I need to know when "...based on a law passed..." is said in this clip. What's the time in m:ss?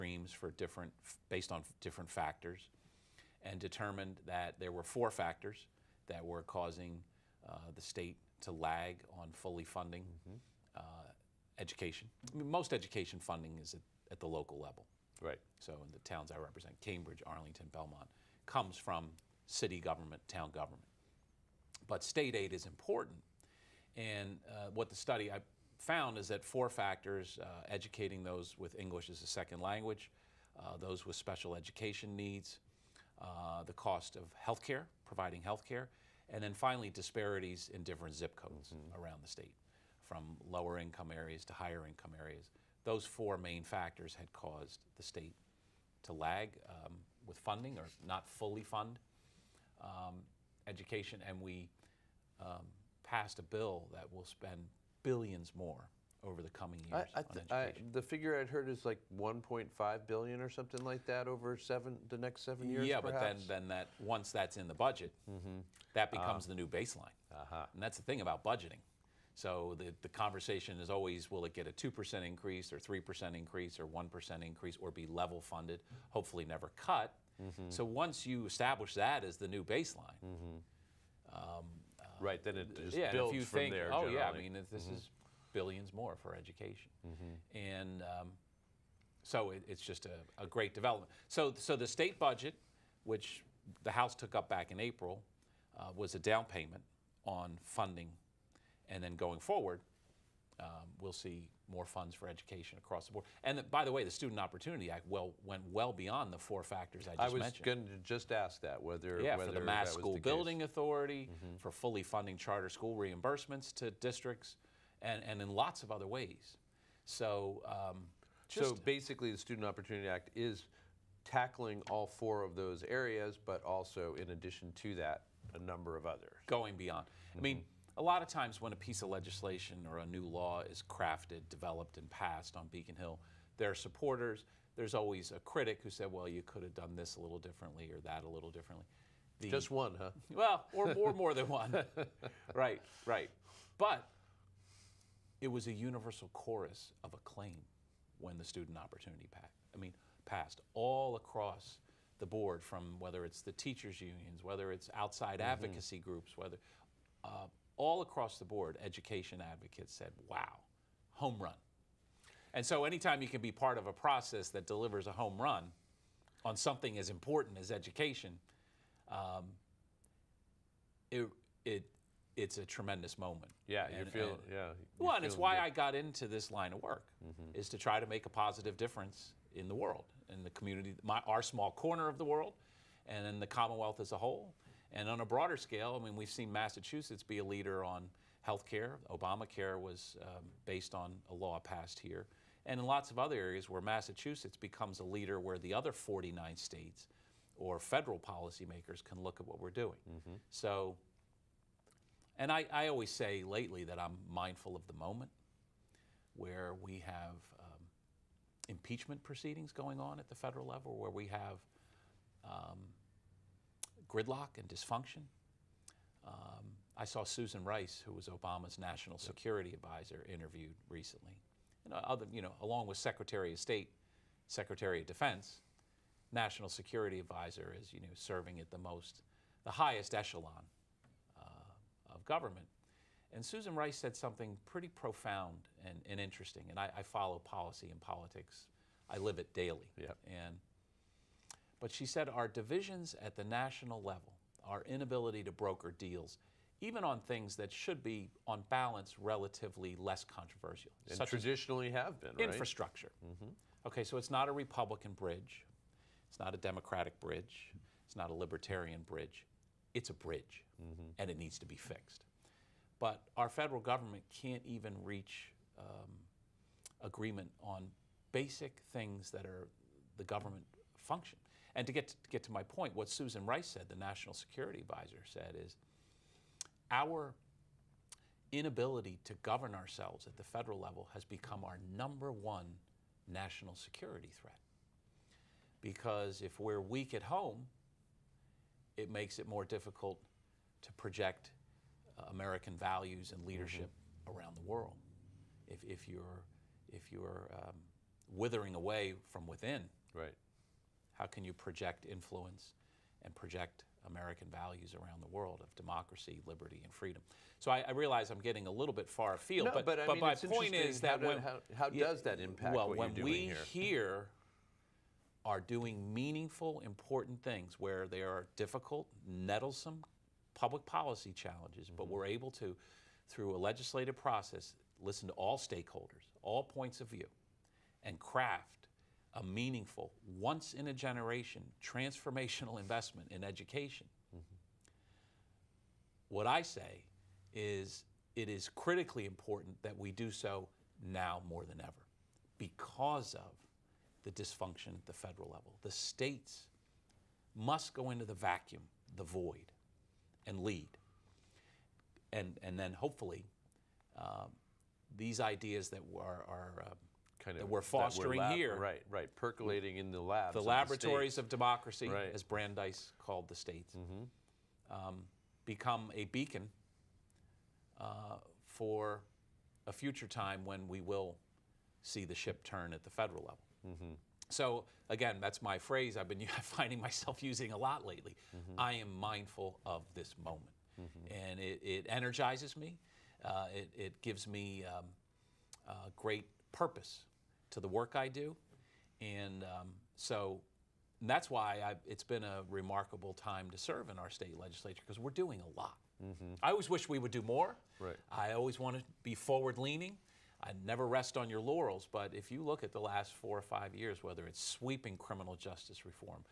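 3:10.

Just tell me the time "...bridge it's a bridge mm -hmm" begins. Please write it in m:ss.
4:19.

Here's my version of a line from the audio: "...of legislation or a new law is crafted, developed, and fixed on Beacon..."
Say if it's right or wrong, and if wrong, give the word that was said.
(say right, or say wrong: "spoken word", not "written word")
wrong: "passed", not "fixed".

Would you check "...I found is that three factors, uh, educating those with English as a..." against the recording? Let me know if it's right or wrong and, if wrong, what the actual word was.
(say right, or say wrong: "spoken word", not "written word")
wrong: "four", not "three".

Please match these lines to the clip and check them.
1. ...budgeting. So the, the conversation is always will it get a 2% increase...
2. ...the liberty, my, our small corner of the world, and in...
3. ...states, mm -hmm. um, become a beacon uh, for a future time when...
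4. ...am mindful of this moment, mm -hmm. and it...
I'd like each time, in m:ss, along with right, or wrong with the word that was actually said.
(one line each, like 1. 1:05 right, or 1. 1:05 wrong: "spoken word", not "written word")
1. 1:08 right
2. 3:00 wrong: "community", not "liberty"
3. 6:03 right
4. 6:19 right.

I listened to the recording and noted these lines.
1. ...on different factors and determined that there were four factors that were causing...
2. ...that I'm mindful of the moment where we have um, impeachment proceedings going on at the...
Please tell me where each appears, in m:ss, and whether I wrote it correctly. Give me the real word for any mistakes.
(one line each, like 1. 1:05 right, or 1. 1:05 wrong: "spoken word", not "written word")
1. 0:01 right
2. 3:23 right.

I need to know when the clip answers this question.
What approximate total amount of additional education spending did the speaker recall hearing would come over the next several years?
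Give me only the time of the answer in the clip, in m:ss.
0:59.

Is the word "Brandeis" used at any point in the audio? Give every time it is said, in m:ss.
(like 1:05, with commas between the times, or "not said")
6:02.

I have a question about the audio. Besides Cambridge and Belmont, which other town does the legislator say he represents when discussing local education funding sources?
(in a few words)
Arlington.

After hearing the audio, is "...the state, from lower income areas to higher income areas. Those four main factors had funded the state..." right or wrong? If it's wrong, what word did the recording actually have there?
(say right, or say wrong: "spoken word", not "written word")
wrong: "caused", not "funded".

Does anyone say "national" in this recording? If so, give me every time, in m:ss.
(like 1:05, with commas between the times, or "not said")
3:38, 3:46, 4:03, 4:33, 4:43.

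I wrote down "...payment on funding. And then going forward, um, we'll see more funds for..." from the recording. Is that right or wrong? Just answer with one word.
right.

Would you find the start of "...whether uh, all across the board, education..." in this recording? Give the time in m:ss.
2:36.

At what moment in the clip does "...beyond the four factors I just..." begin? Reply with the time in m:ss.
1:46.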